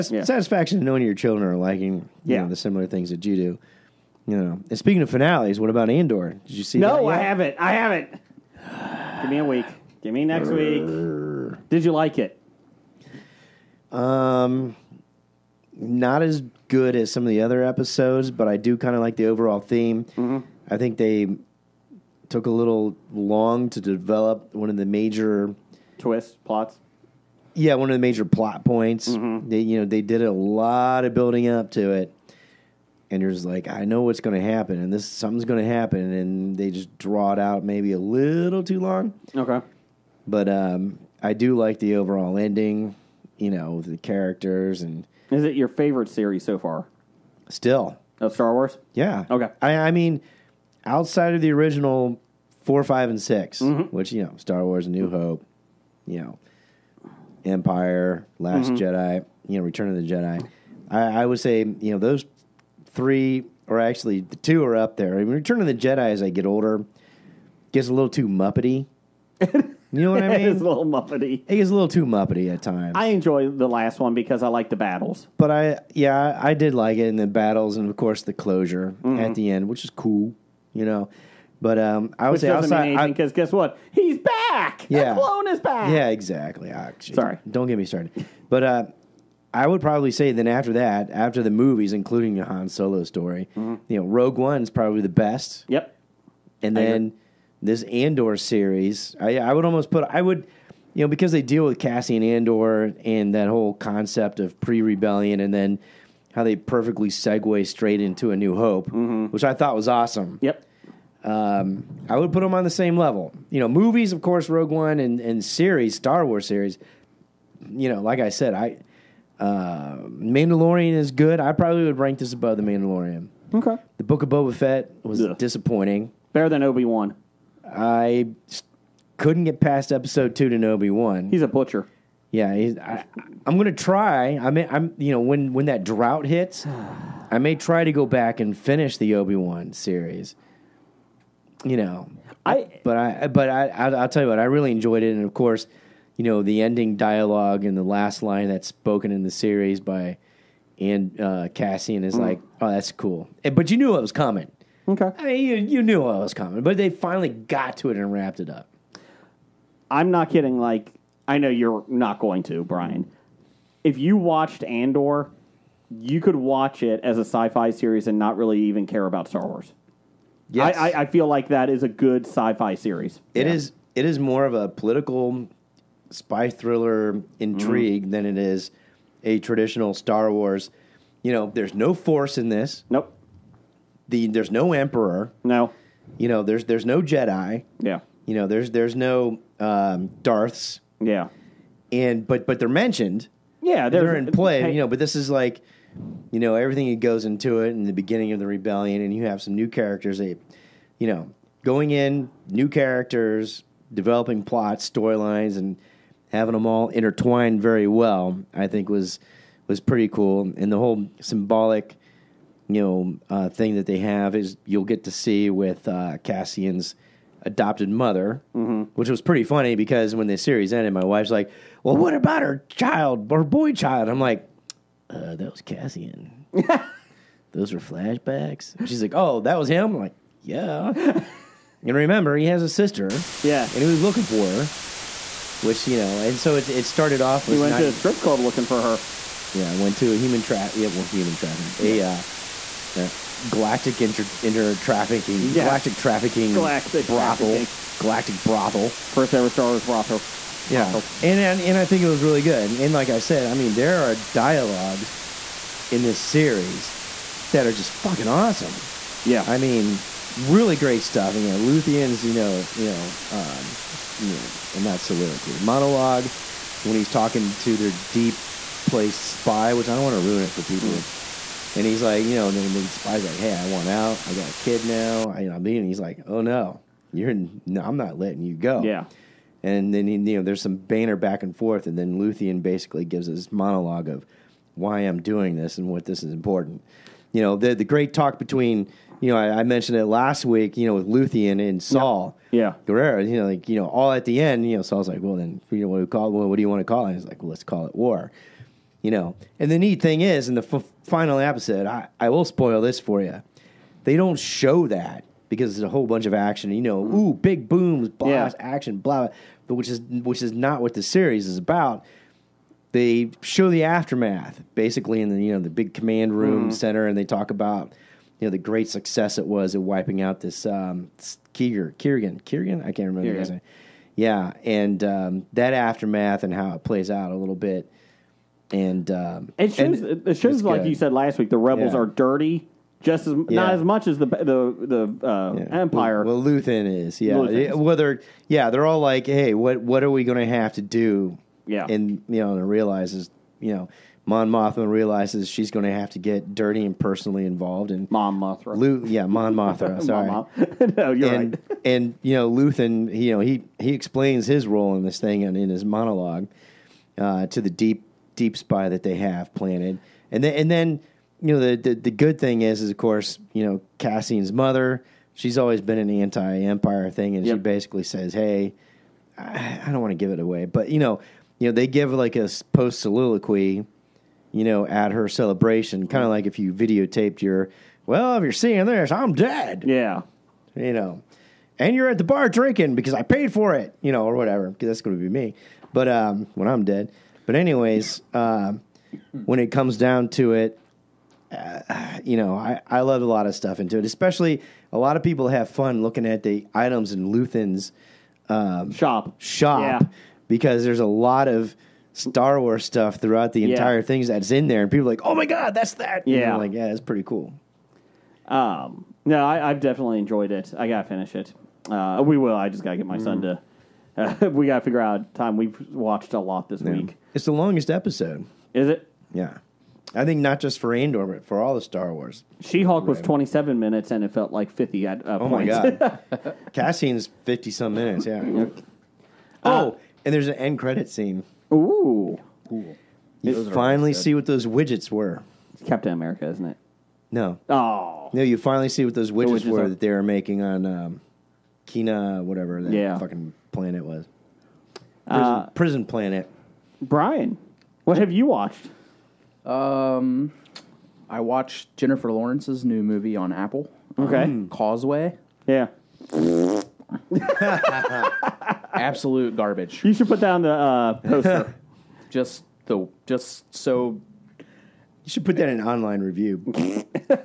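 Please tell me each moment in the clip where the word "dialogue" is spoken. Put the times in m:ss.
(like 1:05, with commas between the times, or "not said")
2:26, 4:14.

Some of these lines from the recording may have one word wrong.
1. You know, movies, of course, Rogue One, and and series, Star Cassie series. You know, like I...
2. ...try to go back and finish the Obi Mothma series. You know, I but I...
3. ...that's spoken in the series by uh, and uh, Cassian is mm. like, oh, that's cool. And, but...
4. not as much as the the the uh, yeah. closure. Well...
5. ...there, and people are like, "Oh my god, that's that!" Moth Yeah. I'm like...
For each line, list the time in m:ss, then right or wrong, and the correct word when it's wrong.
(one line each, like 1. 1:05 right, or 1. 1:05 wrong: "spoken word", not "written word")
1. 1:53 wrong: "Wars", not "Cassie"
2. 2:17 wrong: "Wan", not "Mothma"
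3. 2:28 right
4. 5:33 wrong: "empire", not "closure"
5. 6:44 wrong: "And", not "Moth".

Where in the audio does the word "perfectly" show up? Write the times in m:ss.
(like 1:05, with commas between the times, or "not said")
1:46.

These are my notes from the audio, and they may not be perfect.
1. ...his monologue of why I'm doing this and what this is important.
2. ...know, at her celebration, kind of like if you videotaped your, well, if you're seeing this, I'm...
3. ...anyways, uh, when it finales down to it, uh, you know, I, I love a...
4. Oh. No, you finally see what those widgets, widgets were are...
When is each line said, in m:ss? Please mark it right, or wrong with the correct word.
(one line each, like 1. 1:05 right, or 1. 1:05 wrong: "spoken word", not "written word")
1. 4:43 right
2. 6:14 right
3. 6:27 wrong: "comes", not "finales"
4. 7:17 right.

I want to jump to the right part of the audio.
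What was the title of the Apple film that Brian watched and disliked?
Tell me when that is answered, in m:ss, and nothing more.
7:34.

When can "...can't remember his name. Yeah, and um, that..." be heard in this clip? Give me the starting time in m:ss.
5:22.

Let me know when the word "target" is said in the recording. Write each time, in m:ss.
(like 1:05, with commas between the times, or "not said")
not said.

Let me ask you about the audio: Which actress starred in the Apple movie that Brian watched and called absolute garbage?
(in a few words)
Jennifer Lawrence.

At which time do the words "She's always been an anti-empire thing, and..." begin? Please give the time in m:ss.
6:05.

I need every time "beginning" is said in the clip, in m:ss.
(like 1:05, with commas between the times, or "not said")
3:17.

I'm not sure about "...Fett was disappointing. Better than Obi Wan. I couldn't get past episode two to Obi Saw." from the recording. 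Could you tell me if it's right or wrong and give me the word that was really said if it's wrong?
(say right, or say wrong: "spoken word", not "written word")
wrong: "Wan", not "Saw".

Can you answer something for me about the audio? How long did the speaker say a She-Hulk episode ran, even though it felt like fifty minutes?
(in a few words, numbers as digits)
27 minutes.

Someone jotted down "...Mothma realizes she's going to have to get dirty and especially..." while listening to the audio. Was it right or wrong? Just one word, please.
wrong.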